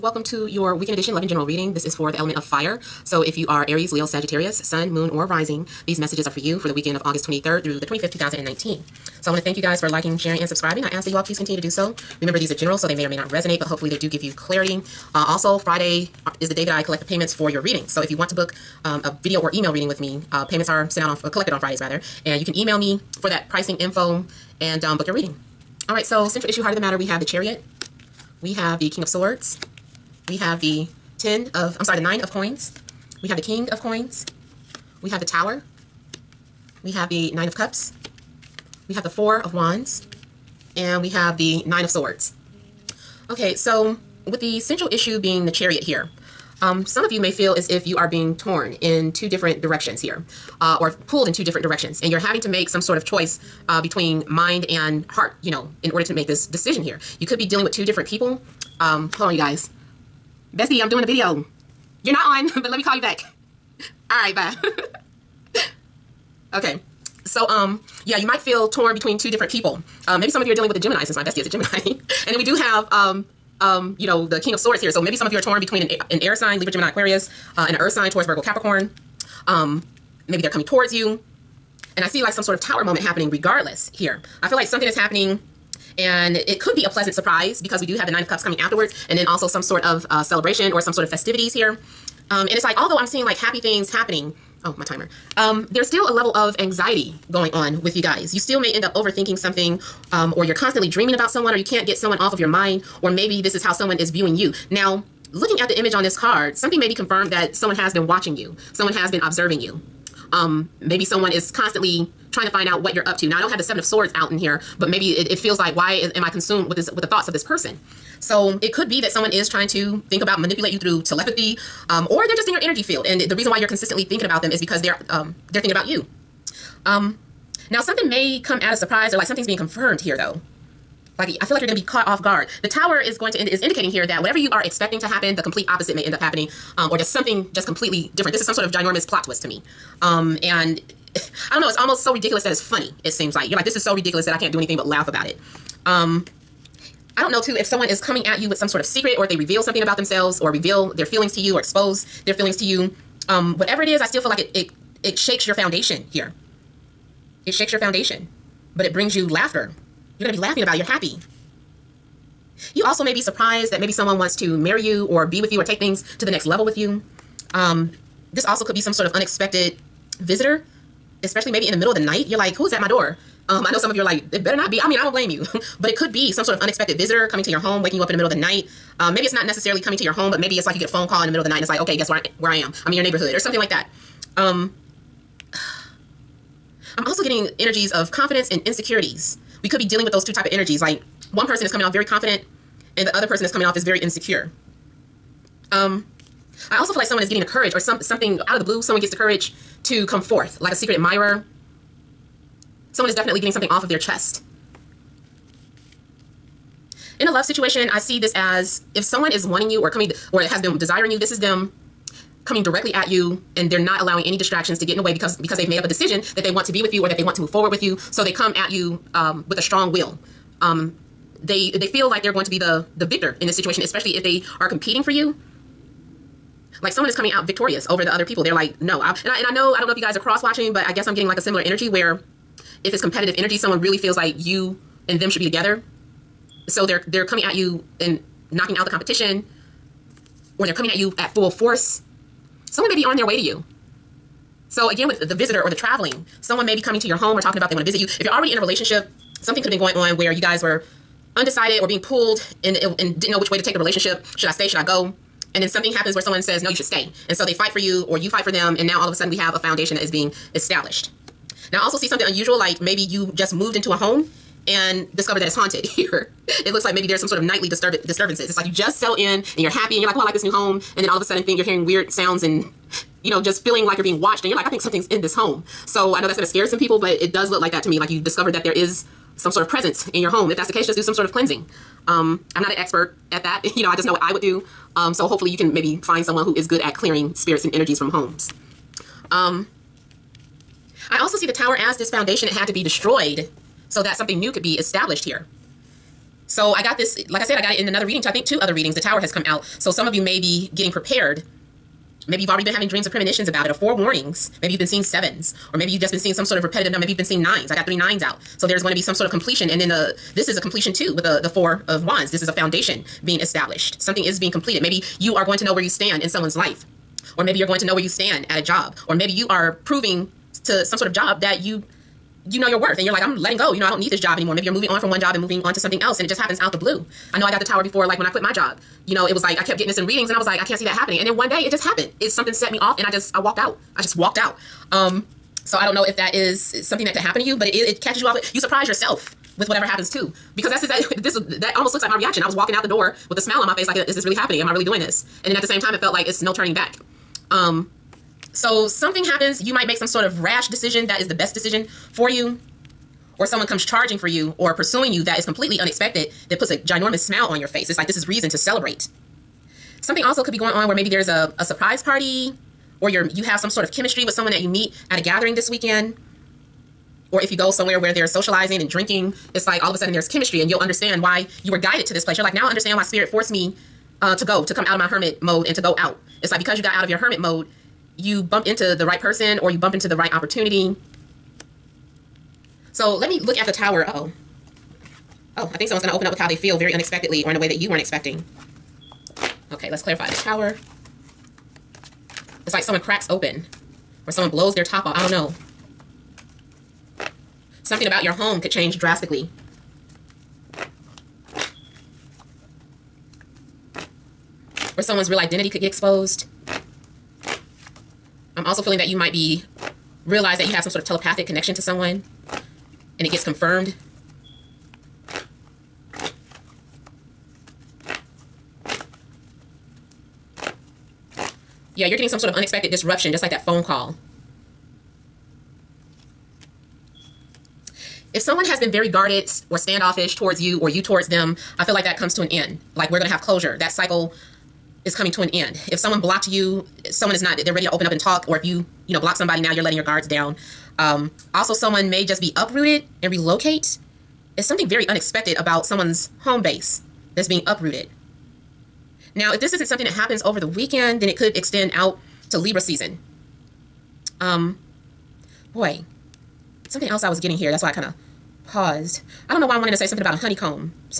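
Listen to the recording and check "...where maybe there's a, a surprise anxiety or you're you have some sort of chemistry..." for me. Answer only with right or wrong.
wrong.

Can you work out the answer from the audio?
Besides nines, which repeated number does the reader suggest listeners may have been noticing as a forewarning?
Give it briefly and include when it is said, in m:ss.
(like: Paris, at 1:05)
sevens, at 5:05.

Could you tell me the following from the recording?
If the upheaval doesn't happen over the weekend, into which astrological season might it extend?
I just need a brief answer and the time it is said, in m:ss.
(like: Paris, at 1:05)
Libra season, at 7:32.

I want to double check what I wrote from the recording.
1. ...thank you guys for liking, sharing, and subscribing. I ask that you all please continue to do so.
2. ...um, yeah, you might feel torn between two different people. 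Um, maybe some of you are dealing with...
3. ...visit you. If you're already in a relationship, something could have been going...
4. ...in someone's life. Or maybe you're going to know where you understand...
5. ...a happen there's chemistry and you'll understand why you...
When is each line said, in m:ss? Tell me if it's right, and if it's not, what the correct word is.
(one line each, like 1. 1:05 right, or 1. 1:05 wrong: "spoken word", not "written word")
1. 0:09 right
2. 1:07 right
3. 4:07 right
4. 5:16 wrong: "stand", not "understand"
5. 6:09 wrong: "sudden", not "happen".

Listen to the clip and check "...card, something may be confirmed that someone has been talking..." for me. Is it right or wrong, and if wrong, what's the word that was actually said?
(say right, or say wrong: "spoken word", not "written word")
wrong: "watching", not "talking".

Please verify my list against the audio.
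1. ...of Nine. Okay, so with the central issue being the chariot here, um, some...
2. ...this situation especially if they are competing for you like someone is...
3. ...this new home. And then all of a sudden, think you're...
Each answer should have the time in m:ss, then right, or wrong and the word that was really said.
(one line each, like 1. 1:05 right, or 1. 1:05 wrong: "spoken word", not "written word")
1. 0:41 wrong: "Swords", not "Nine"
2. 3:43 right
3. 4:30 right.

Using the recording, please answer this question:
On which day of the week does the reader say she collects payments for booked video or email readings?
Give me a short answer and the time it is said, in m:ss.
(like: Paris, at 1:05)
Friday, at 0:15.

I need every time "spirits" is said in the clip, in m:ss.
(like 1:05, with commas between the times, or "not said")
4:47, 6:13.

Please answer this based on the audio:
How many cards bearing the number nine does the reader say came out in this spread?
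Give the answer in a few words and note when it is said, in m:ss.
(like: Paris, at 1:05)
3, at 5:07.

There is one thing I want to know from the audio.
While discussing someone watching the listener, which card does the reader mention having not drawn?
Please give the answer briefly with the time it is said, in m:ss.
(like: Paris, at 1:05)
Seven of Swords, at 1:53.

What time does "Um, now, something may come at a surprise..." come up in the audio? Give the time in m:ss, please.
2:06.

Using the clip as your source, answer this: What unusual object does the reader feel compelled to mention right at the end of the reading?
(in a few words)
honeycomb.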